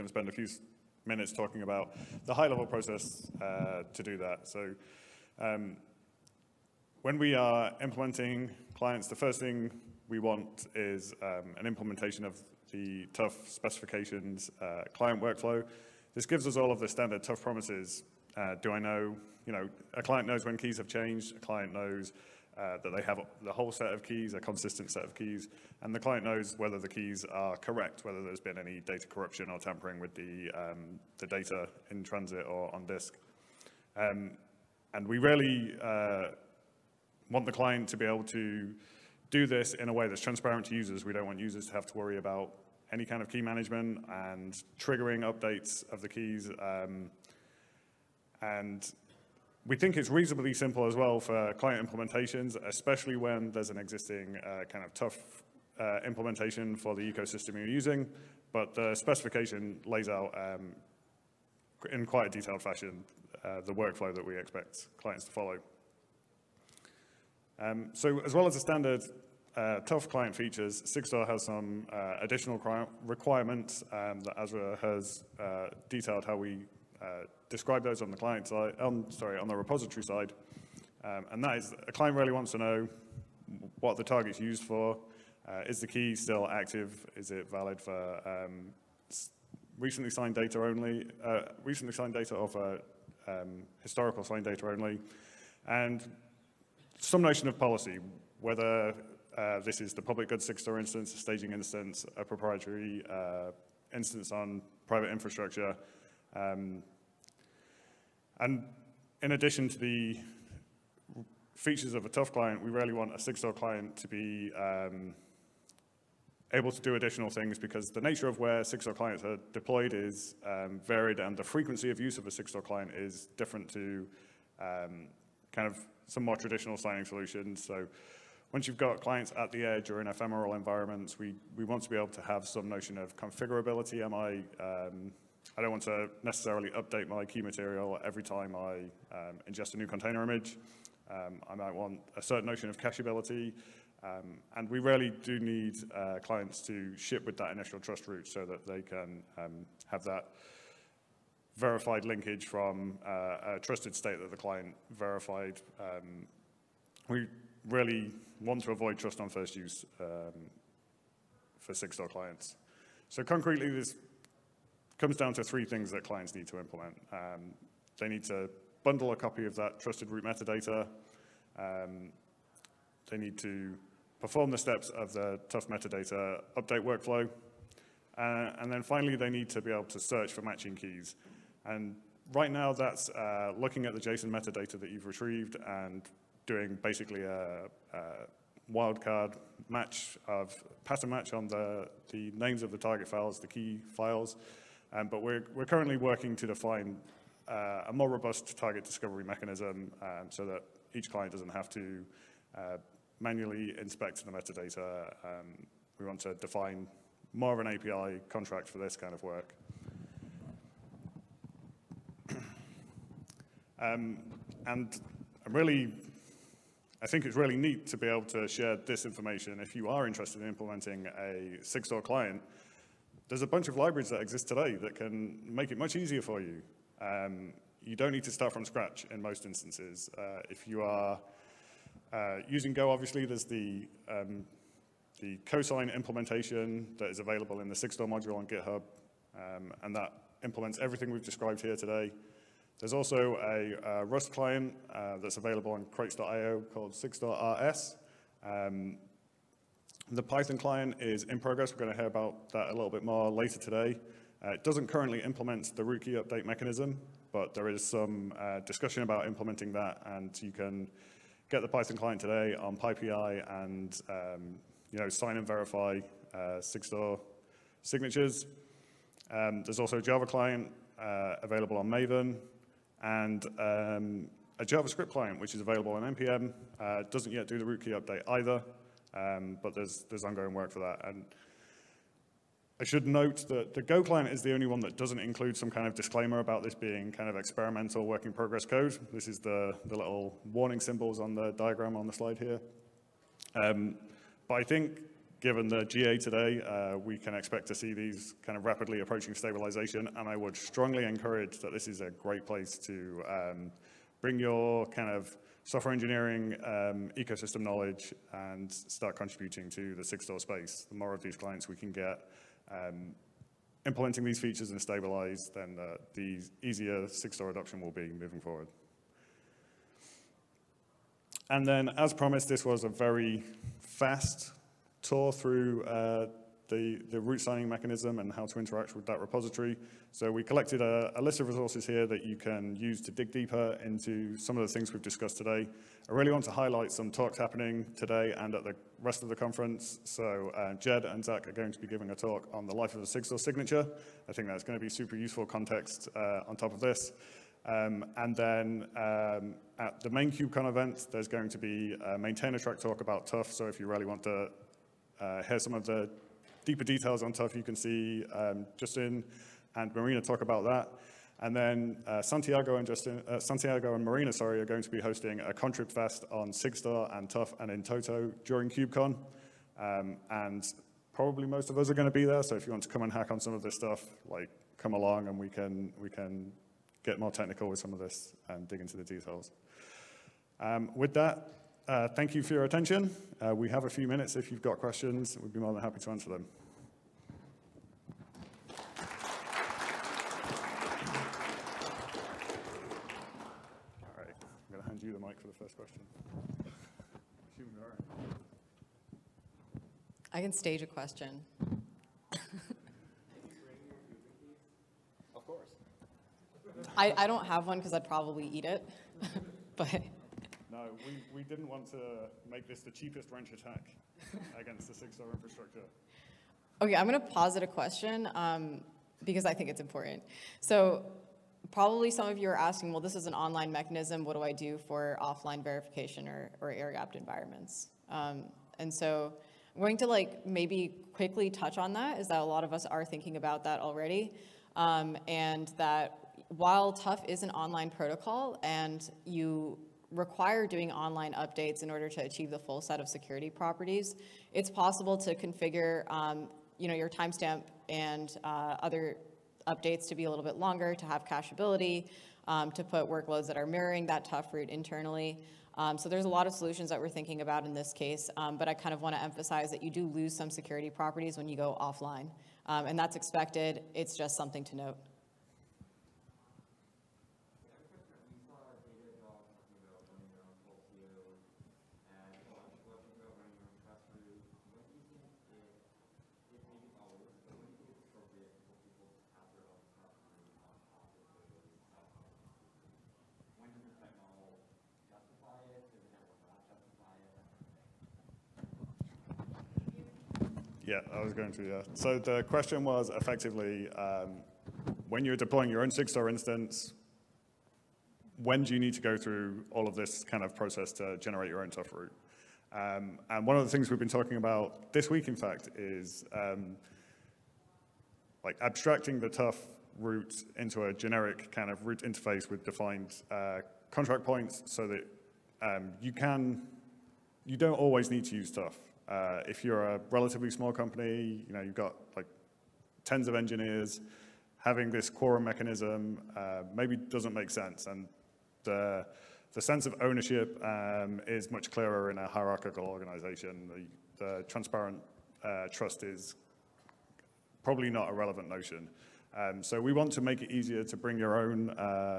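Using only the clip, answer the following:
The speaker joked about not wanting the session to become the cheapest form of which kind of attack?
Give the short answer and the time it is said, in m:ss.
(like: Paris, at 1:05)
Wrench attack, at 6:53.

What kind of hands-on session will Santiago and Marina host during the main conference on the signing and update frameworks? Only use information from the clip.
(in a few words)
Contrib Fest.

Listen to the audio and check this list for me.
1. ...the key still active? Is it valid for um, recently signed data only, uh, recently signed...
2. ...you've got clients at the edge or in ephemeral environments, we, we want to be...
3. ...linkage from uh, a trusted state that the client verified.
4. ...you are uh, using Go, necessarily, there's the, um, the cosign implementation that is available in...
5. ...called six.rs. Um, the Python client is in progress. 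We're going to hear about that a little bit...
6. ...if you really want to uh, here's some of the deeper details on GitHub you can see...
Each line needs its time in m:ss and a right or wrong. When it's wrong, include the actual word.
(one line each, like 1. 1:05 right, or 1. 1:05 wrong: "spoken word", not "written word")
1. 1:25 right
2. 2:08 right
3. 2:32 right
4. 3:50 wrong: "obviously", not "necessarily"
5. 4:06 right
6. 5:53 wrong: "TUF", not "GitHub".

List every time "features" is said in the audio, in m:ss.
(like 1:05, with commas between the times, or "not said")
1:10, 1:51, 5:14.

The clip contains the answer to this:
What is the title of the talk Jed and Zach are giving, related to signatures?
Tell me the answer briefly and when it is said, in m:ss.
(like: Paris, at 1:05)
The life of a Sigstore signature, at 5:42.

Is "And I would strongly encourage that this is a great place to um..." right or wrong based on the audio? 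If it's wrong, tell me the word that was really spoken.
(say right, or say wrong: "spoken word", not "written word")
right.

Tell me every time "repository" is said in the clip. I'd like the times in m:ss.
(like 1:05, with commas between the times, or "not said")
1:19, 5:29.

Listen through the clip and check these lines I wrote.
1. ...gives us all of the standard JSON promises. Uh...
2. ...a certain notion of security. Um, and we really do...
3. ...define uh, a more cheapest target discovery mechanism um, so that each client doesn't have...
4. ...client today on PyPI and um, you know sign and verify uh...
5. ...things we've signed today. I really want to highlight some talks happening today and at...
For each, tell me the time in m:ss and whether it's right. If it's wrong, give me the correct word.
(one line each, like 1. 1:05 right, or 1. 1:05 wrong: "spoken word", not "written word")
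1. 0:16 wrong: "TUF", not "JSON"
2. 2:22 wrong: "cacheability", not "security"
3. 3:16 wrong: "robust", not "cheapest"
4. 4:21 right
5. 5:34 wrong: "discussed", not "signed".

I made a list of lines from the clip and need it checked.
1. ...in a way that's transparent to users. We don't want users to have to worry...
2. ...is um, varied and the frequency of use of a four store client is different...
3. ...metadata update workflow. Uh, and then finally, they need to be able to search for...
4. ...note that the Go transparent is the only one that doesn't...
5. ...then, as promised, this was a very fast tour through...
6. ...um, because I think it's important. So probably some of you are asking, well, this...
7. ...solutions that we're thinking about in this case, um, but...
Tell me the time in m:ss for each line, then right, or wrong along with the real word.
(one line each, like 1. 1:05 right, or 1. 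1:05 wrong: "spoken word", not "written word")
1. 0:39 right
2. 1:59 wrong: "six", not "four"
3. 2:55 right
4. 4:43 wrong: "client", not "transparent"
5. 5:21 right
6. 6:58 right
7. 7:36 right.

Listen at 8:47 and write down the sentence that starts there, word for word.
And the, the sense of ownership um, is much clearer in a hierarchical organization.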